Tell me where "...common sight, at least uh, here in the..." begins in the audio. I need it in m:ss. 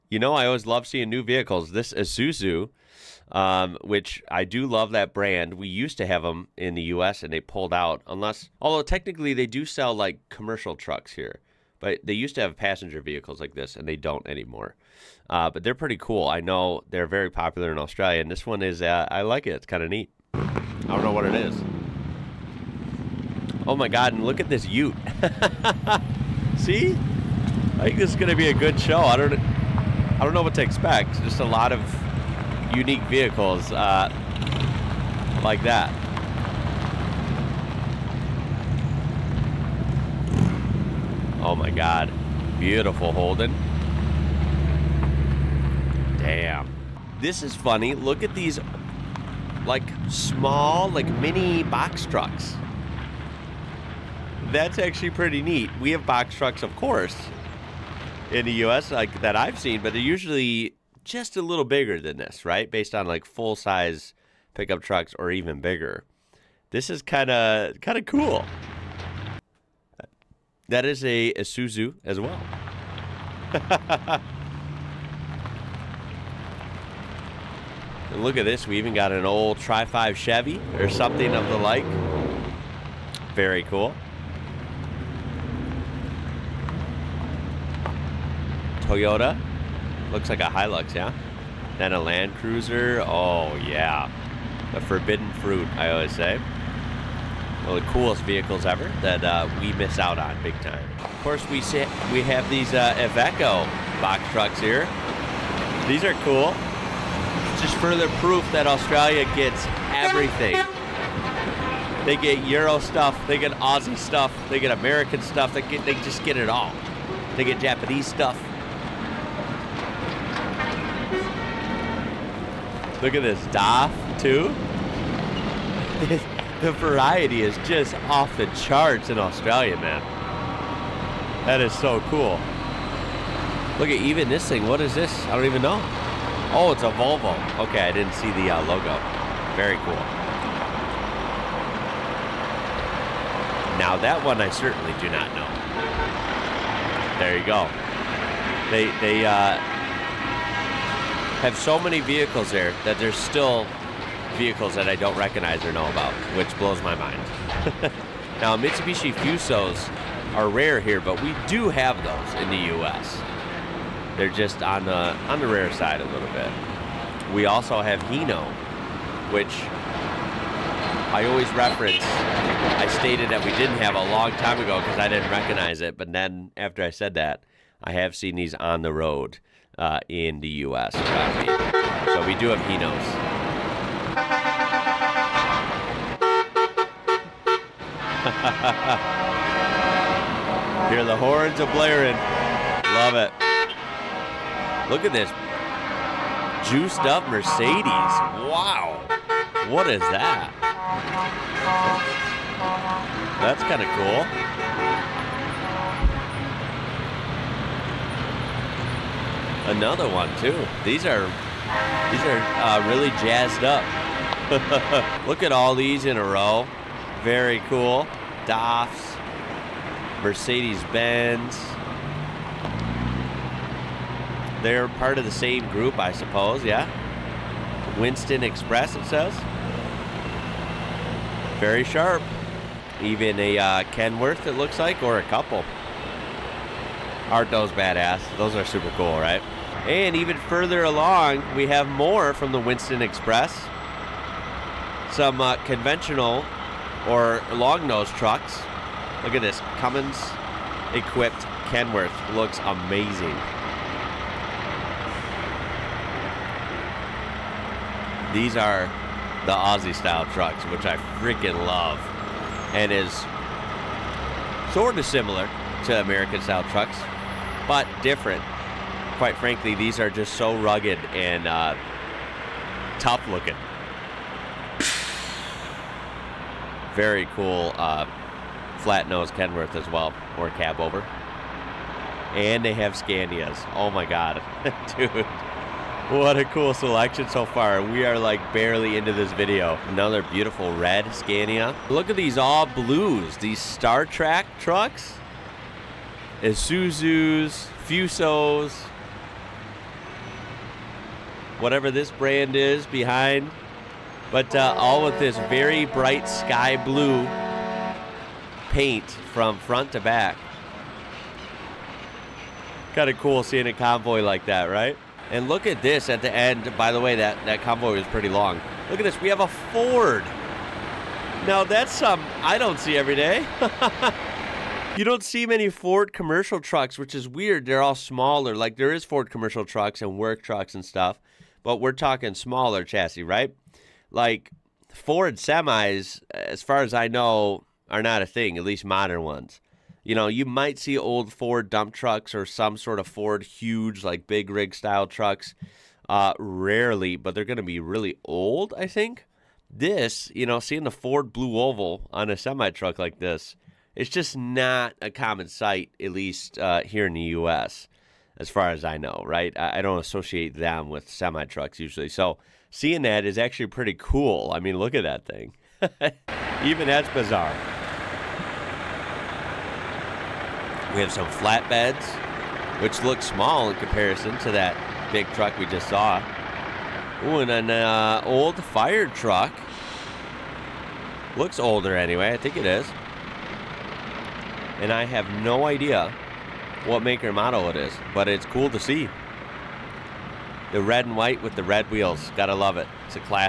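5:55.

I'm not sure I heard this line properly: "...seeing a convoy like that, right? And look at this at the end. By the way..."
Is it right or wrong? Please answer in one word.
right.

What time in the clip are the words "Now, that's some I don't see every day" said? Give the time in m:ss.
5:21.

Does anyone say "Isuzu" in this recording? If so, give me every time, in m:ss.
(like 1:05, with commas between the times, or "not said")
0:01, 1:11, 4:56.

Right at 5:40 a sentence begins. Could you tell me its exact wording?
You know, you might see old Ford dump trucks or some sort of Ford huge, like big rig style trucks.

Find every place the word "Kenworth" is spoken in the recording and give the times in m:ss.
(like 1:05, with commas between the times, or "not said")
3:53, 4:11, 4:39.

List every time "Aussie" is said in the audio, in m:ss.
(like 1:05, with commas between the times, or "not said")
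1:53, 4:19.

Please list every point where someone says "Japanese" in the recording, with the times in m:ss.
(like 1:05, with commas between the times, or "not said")
1:57.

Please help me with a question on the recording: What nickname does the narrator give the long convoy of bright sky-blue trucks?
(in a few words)
Star Trek trucks.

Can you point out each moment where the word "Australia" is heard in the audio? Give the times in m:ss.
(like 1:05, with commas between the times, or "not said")
0:17, 1:48, 2:09.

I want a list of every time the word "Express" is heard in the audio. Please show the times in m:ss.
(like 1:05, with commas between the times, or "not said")
3:48, 4:03.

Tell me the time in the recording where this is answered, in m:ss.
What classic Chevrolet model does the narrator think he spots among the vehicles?
1:19.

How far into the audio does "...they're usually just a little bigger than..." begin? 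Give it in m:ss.
0:59.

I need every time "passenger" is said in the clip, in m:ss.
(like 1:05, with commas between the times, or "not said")
0:12.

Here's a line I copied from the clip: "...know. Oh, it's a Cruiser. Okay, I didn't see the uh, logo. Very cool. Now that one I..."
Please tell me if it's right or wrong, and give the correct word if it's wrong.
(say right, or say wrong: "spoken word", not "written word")
wrong: "Volvo", not "Cruiser".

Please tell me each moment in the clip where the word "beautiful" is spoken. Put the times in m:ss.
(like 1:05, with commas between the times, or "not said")
0:42, 4:50.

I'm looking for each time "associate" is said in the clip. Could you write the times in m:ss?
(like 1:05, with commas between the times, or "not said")
5:59.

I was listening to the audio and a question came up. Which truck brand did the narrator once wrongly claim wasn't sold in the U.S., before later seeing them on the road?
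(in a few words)
Hino.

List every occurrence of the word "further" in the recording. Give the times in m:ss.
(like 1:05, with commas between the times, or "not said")
1:47, 4:00.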